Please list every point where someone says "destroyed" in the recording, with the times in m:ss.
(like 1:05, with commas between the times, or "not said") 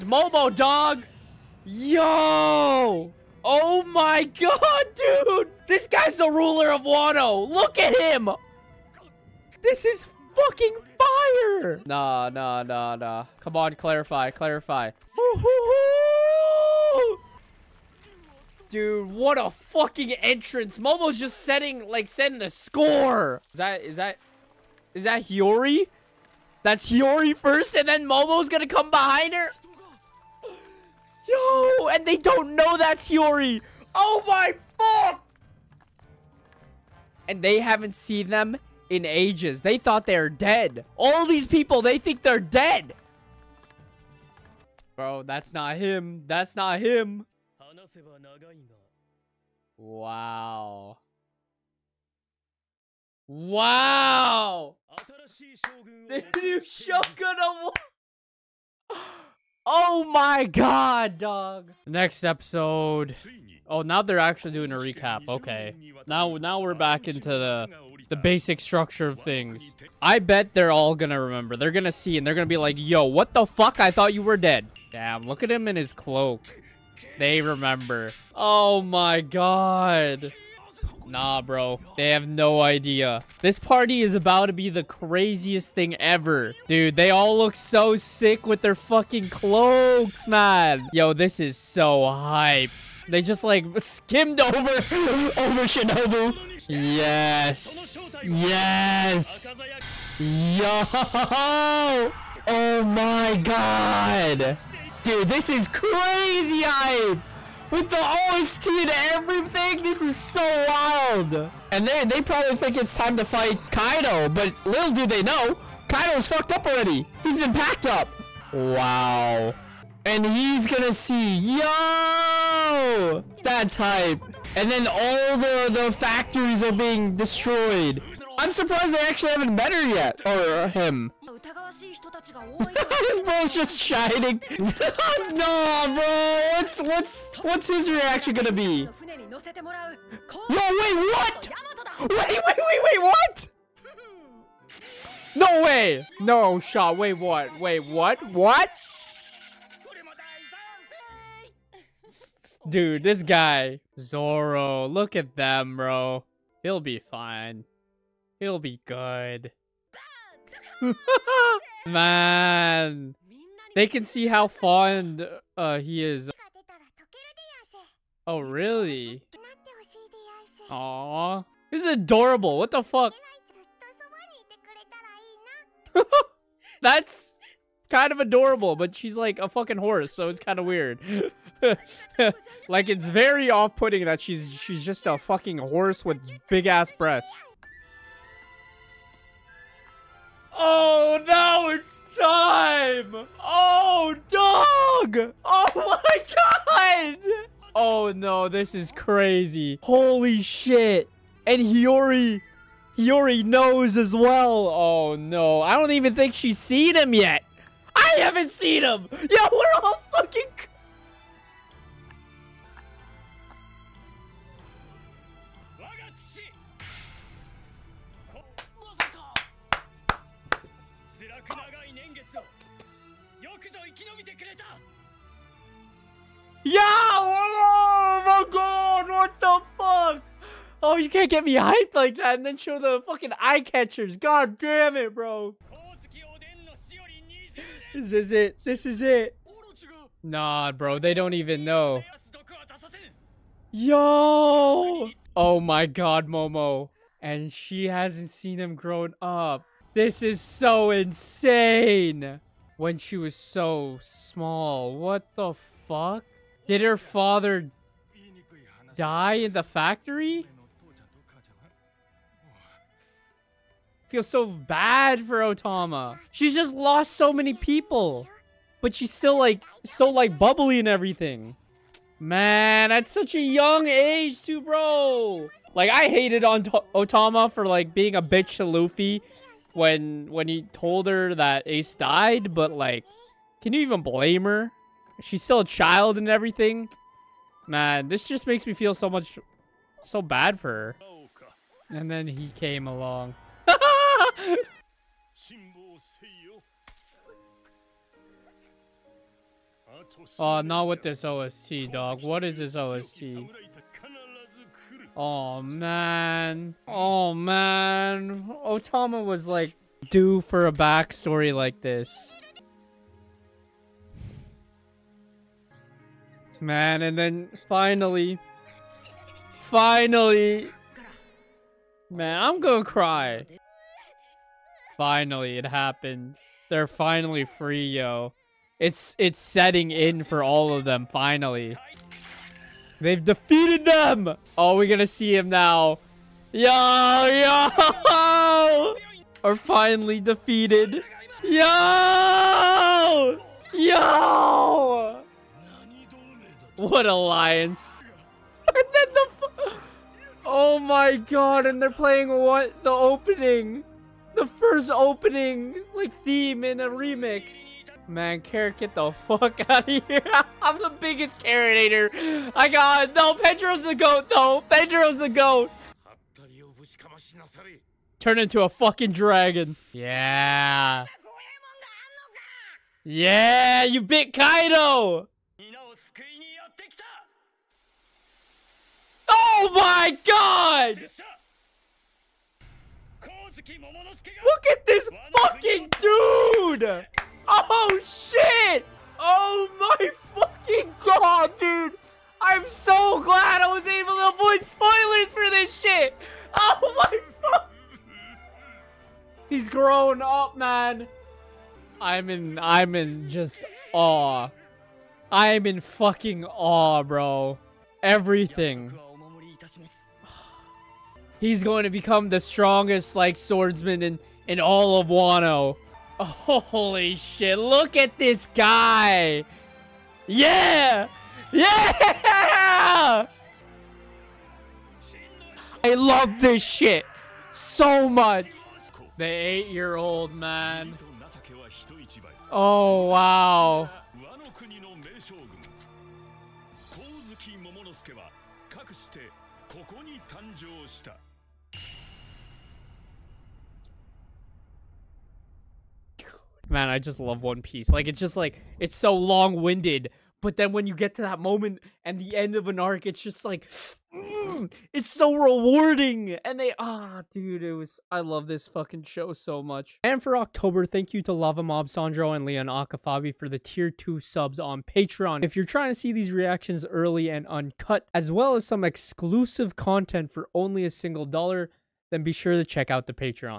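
2:07.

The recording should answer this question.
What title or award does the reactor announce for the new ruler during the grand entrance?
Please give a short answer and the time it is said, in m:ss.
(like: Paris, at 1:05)
The new Shogun, at 0:56.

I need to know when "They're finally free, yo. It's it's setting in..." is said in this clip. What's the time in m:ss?
5:26.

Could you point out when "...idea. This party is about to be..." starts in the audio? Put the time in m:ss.
1:22.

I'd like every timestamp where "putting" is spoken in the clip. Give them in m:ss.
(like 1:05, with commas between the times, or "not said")
3:03.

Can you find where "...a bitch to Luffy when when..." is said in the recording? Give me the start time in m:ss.
4:38.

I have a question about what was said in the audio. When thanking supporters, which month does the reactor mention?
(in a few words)
October.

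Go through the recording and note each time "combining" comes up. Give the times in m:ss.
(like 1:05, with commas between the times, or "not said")
not said.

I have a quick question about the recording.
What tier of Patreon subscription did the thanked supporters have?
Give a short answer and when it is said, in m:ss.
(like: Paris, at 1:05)
Tier 2, at 7:43.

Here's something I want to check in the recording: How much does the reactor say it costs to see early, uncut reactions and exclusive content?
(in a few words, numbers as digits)
1 dollar.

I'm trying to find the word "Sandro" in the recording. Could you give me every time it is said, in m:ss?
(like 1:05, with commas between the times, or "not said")
7:41.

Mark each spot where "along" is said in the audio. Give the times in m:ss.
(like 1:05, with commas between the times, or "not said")
4:52.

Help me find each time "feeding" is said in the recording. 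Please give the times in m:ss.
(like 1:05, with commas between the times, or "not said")
not said.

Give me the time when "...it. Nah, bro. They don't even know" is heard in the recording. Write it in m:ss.
3:59.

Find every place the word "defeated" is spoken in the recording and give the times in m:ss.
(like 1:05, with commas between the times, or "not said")
5:33, 5:40.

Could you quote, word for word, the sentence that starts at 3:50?
Oh, you can't get me hyped like that and then show the fucking eye catchers.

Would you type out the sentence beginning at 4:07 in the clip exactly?
And she hasn't seen him grown up.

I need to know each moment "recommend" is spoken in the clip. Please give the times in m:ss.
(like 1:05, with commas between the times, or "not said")
not said.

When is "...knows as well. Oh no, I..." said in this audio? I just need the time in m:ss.
3:23.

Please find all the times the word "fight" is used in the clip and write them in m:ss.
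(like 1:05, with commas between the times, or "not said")
1:53.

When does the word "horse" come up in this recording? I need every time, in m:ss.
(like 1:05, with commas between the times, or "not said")
2:59, 3:05.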